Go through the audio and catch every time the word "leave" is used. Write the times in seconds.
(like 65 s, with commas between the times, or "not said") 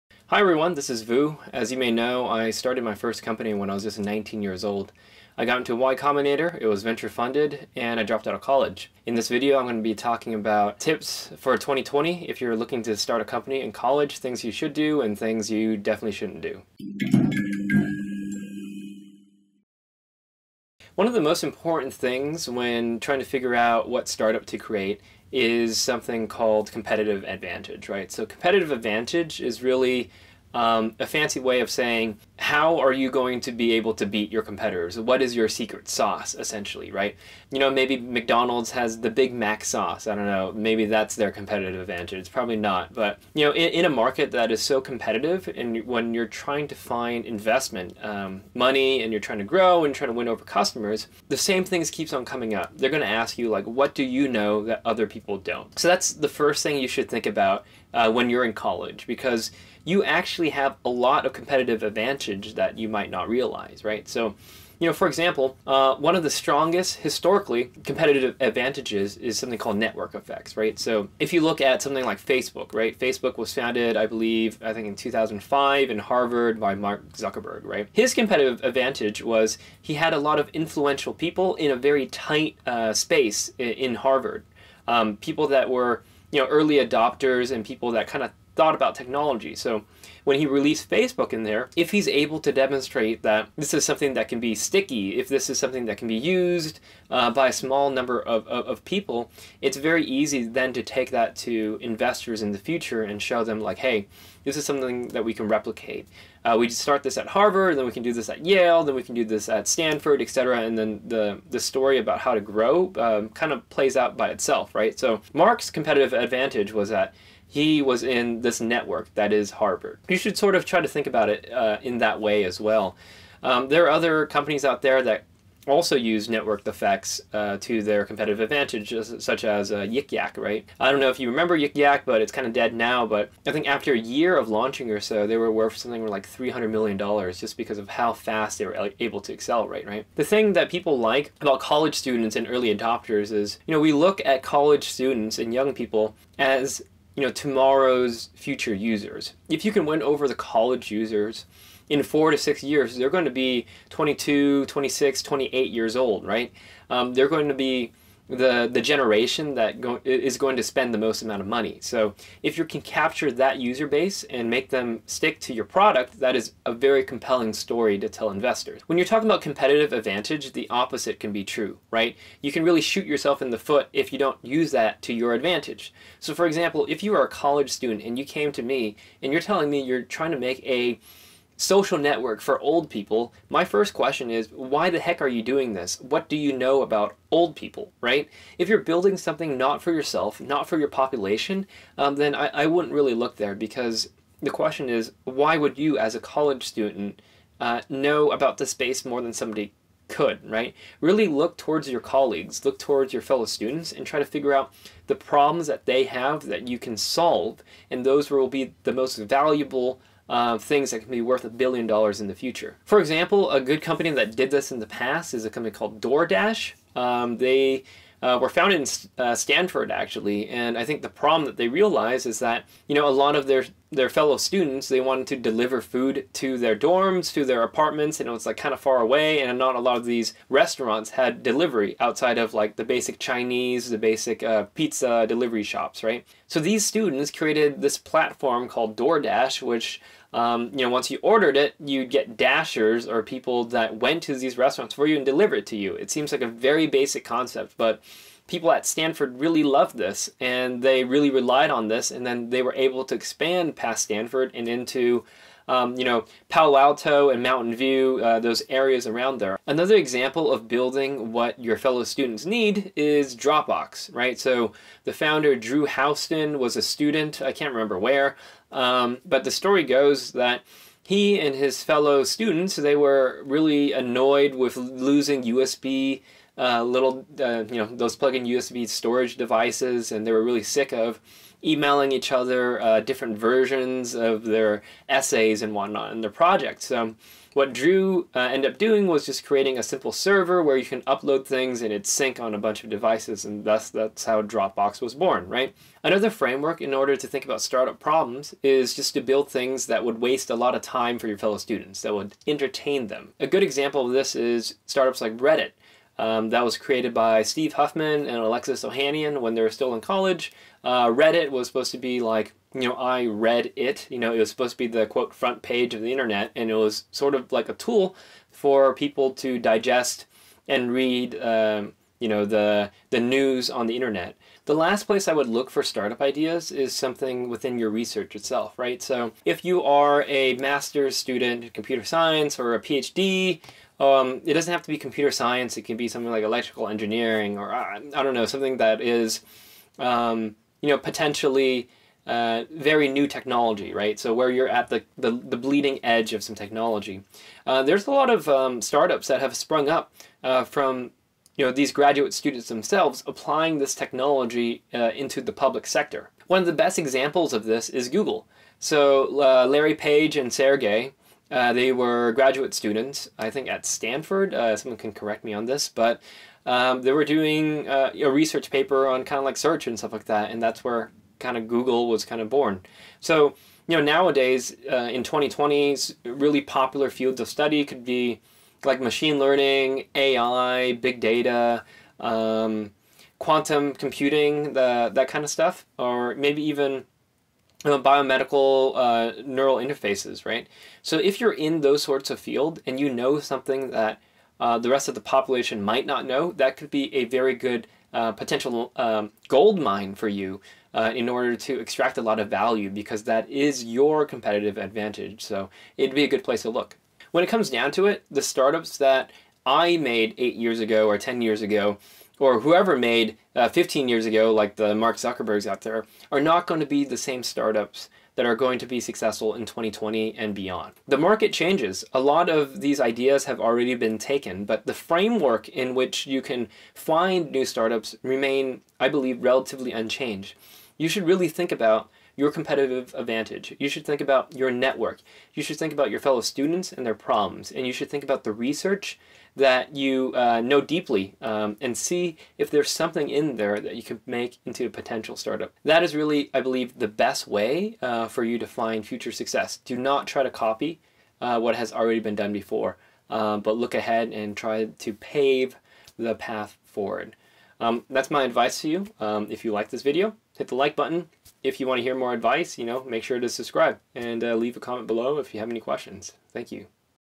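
464 s.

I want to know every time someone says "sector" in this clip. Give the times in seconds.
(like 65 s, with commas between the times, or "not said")
355 s.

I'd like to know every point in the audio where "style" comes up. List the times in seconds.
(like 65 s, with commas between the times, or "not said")
not said.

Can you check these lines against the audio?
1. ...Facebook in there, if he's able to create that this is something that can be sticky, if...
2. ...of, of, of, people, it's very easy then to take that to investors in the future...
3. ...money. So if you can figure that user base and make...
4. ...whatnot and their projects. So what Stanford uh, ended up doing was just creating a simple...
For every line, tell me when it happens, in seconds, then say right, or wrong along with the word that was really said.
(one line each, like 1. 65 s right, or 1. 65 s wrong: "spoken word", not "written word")
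1. 90 s wrong: "demonstrate", not "create"
2. 98 s right
3. 161 s wrong: "capture", not "figure"
4. 285 s wrong: "Drew", not "Stanford".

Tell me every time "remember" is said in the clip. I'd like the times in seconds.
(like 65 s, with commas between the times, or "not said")
131 s, 267 s.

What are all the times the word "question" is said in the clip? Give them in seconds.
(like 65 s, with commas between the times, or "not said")
183 s, 194 s, 465 s.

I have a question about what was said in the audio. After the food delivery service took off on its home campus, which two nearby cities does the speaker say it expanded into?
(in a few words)
Palo Alto and Mountain View.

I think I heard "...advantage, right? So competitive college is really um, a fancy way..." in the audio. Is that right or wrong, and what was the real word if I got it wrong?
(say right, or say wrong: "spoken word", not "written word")
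wrong: "advantage", not "college".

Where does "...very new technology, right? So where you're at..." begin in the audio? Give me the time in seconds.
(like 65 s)
342 s.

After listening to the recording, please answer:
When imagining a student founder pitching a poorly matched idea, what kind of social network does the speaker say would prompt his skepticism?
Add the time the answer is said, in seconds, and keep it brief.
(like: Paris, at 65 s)
a social network for old people, at 181 s.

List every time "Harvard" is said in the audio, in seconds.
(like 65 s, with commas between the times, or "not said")
75 s, 83 s, 107 s, 119 s.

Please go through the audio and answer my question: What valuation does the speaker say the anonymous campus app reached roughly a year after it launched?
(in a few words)
$300 million.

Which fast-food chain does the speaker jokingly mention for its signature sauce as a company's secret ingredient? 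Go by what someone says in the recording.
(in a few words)
McDonald's.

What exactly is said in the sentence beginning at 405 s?
So it'd be a good place to look.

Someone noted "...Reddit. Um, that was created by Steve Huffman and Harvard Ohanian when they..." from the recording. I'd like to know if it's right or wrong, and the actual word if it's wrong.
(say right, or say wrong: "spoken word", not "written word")
wrong: "Alexis", not "Harvard".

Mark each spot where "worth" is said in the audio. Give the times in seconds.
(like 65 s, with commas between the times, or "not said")
135 s, 211 s.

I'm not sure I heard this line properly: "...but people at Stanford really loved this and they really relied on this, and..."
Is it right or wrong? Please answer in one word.
right.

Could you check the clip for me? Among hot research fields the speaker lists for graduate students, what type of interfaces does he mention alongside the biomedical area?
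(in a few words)
neural interfaces.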